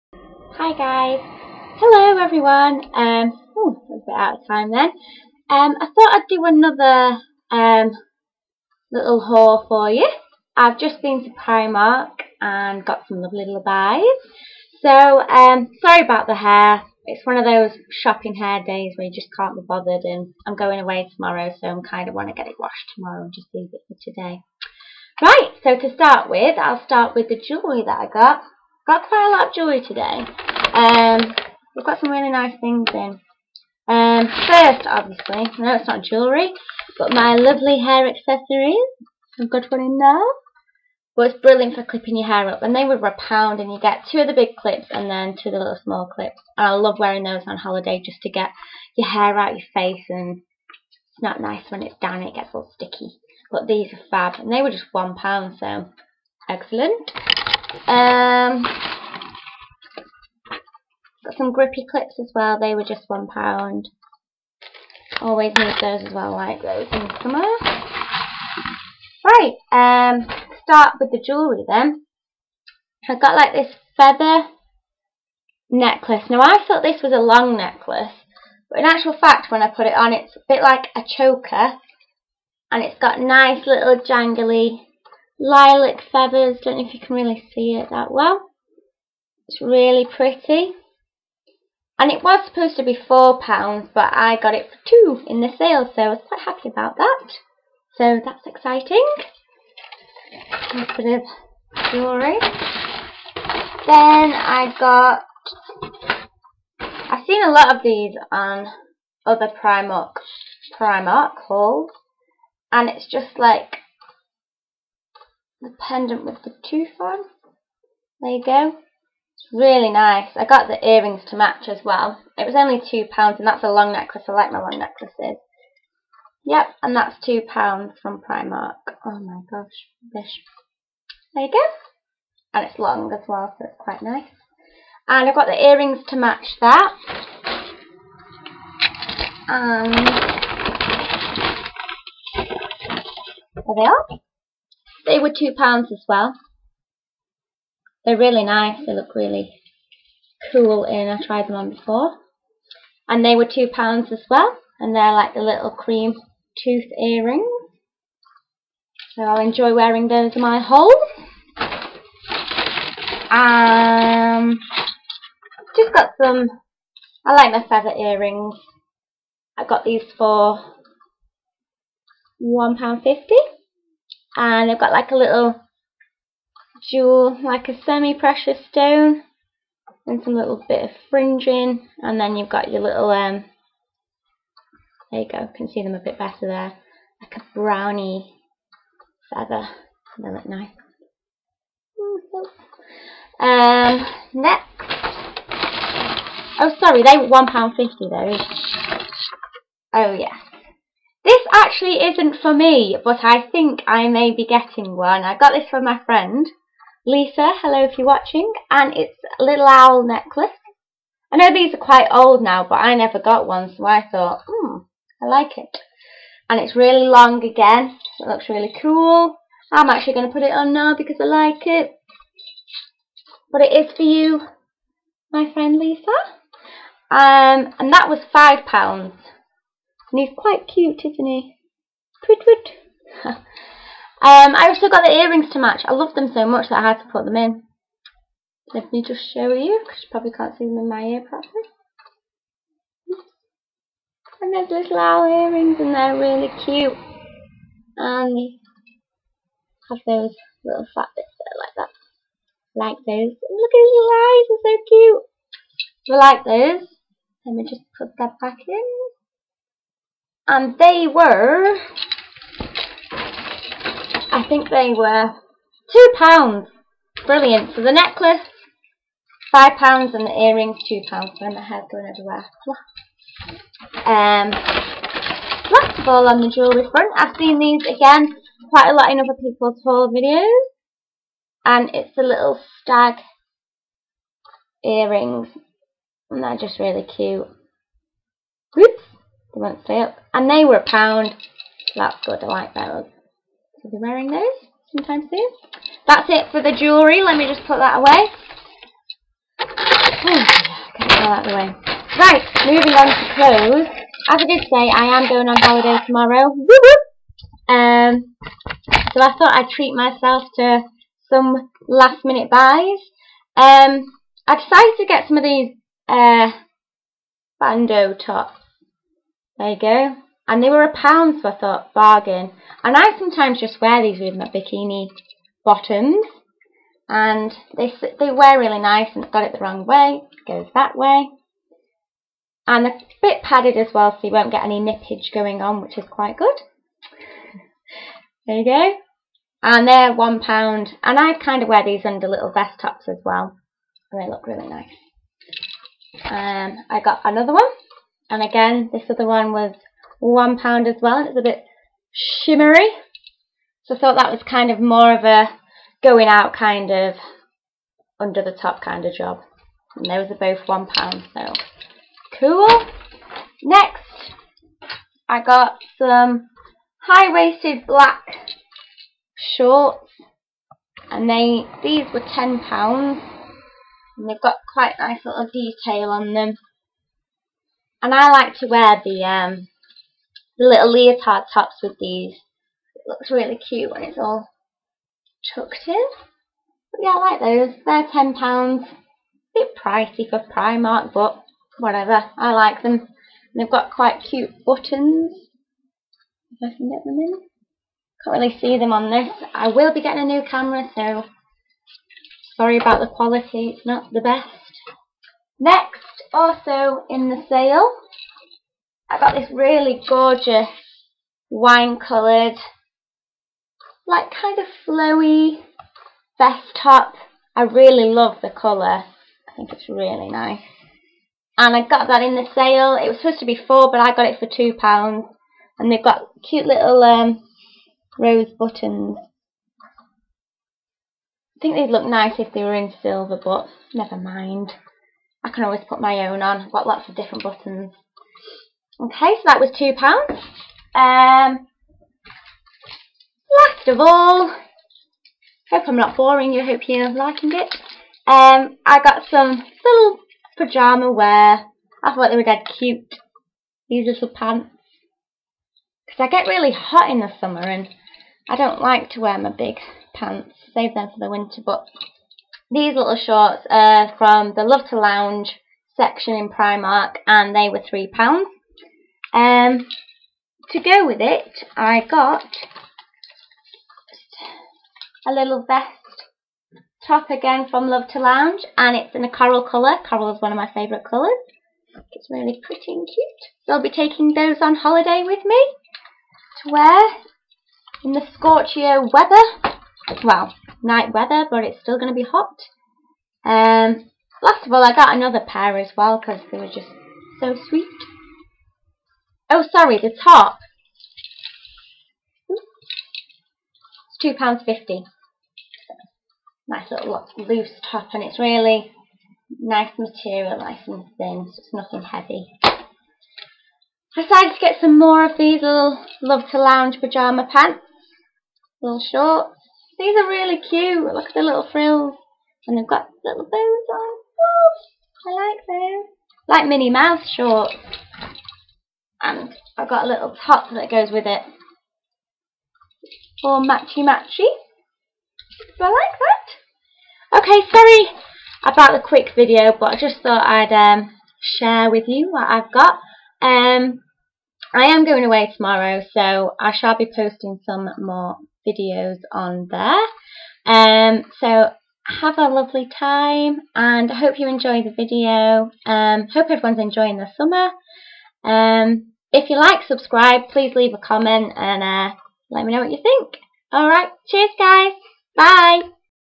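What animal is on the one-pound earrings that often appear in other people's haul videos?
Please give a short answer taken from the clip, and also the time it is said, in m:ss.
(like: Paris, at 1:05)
Stag, at 4:42.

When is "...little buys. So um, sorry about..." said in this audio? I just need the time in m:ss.
0:13.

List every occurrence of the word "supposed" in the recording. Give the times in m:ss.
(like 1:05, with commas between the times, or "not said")
1:32, 7:03.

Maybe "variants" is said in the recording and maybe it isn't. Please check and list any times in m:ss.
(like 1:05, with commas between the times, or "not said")
not said.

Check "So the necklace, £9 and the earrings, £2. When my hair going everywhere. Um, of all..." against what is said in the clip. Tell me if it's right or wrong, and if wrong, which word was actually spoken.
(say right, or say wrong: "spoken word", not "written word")
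wrong: "5", not "9".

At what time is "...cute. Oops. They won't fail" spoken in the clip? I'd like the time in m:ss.
4:47.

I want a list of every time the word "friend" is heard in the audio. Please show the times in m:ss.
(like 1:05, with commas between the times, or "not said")
3:26, 3:45.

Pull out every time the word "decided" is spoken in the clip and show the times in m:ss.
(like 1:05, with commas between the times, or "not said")
5:14, 8:34.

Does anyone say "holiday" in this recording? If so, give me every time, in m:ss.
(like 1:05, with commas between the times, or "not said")
0:47, 5:05, 8:04.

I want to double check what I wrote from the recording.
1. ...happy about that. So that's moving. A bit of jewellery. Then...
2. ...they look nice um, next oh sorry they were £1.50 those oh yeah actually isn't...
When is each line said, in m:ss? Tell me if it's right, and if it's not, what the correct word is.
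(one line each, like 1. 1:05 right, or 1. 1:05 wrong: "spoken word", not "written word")
1. 1:36 wrong: "exciting", not "moving"
2. 3:10 right.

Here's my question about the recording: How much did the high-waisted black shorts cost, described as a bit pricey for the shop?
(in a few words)
£10.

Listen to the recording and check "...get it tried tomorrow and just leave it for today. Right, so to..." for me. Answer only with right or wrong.
wrong.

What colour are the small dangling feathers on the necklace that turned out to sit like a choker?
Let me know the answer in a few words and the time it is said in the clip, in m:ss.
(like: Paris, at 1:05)
Lilac, at 1:25.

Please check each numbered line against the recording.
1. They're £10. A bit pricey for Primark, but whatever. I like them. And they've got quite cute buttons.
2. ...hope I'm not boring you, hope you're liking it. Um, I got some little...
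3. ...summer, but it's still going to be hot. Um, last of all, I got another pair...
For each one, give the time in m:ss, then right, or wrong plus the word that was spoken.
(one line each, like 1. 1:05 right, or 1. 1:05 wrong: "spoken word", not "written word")
1. 6:27 right
2. 7:25 right
3. 8:11 wrong: "weather", not "summer".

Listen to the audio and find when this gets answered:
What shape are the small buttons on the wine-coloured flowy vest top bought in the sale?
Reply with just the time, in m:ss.
7:08.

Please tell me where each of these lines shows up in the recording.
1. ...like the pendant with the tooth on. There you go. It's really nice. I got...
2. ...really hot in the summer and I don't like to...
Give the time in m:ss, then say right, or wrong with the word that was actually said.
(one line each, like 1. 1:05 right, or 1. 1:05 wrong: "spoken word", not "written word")
1. 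1:53 right
2. 7:36 right.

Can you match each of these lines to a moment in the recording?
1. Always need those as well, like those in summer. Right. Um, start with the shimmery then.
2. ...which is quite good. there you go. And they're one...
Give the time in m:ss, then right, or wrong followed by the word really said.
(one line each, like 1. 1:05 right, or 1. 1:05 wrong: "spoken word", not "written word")
1. 1:05 wrong: "jewellery", not "shimmery"
2. 5:35 right.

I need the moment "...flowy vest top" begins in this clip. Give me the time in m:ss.
6:54.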